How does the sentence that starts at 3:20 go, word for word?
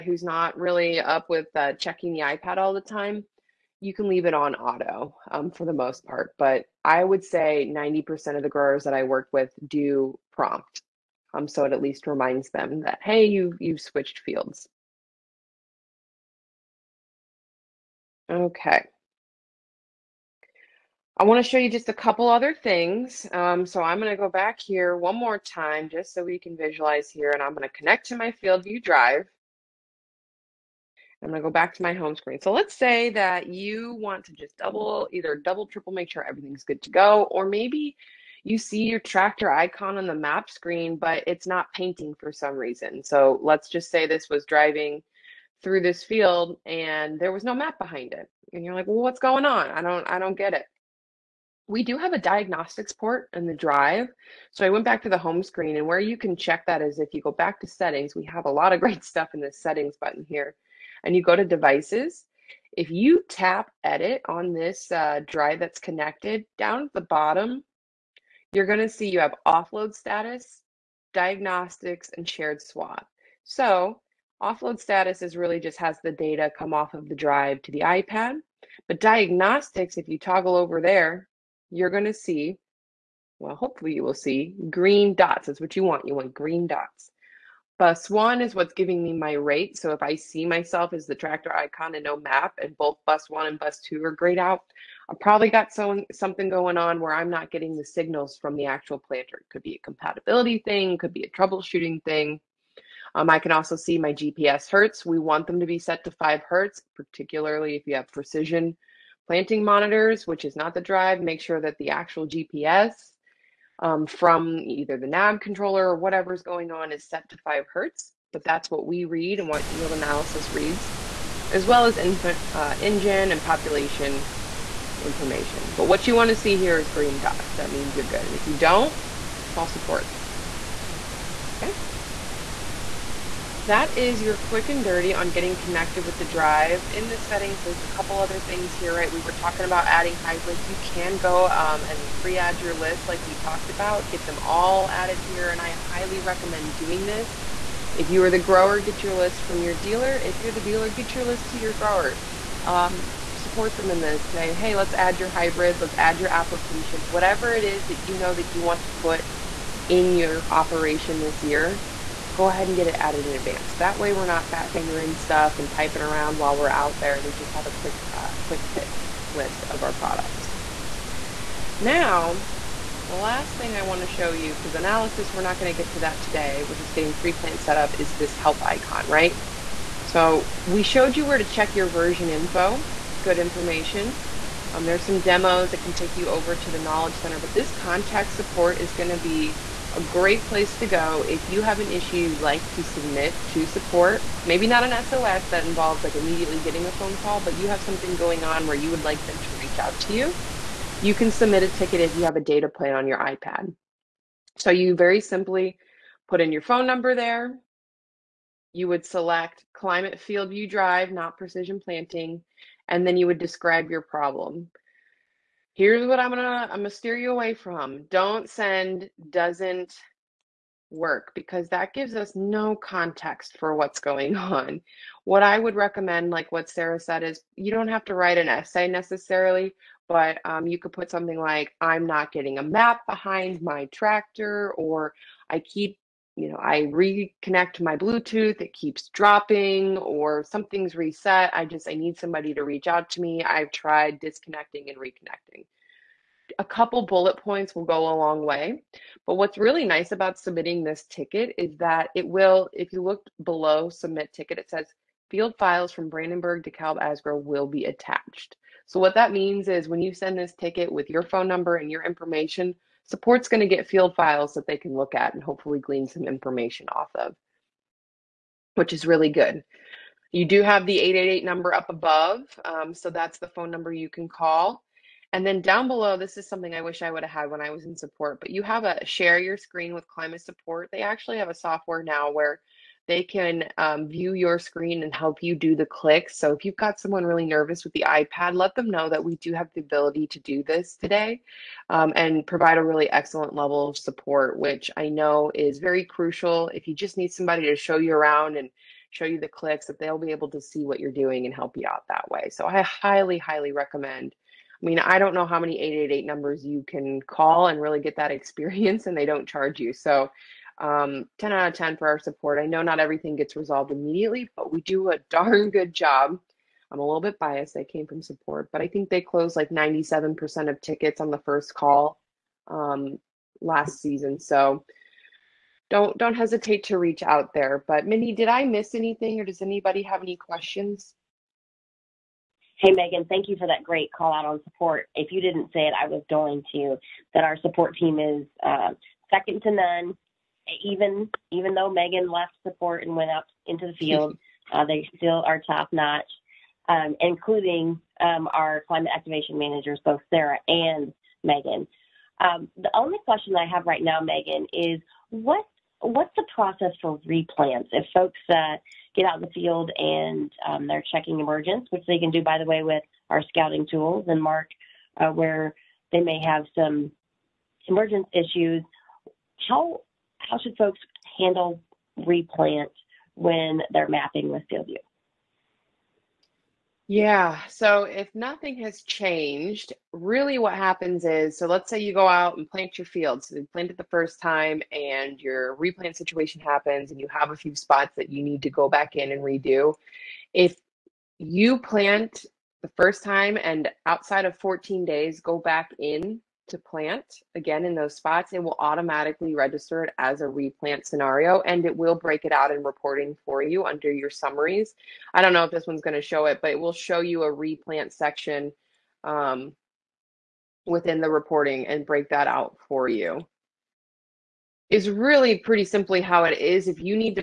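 You can submit a ticket if you have a data plan on your iPad.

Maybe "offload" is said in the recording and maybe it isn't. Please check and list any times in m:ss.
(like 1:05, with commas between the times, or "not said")
1:09, 1:14.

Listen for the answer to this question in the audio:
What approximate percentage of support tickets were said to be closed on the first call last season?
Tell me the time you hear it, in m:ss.
5:19.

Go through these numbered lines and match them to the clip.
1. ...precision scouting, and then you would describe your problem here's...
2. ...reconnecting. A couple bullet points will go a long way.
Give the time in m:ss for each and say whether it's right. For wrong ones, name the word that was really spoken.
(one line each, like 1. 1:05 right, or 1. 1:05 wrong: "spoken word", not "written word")
1. 3:31 wrong: "planting", not "scouting"
2. 4:04 right.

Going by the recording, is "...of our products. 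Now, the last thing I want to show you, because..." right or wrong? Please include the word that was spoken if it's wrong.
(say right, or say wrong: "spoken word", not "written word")
right.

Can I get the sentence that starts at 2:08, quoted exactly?
And if you don't, call support.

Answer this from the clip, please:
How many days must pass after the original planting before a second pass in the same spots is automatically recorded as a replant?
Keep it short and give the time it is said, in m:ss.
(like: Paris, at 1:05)
14, at 6:34.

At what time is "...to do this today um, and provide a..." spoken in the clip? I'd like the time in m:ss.
4:50.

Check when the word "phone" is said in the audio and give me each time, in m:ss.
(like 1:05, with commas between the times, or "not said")
3:16, 3:26, 4:21, 4:33.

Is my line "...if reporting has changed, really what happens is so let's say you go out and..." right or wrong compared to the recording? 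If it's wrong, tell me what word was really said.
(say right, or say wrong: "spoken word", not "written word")
wrong: "nothing", not "reporting".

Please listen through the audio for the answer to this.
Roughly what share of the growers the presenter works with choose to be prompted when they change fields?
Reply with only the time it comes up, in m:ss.
0:07.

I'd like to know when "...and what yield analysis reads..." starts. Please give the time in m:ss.
1:59.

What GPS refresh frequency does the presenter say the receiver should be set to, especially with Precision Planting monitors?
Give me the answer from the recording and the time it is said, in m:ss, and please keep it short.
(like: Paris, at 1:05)
5 hertz, at 1:46.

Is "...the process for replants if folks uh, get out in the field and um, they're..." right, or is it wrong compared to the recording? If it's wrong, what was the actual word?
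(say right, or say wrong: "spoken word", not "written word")
right.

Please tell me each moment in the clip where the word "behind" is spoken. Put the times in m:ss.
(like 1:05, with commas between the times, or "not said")
0:47, 3:53.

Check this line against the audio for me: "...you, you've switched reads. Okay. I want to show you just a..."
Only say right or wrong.
wrong.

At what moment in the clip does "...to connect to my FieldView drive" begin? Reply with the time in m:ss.
0:27.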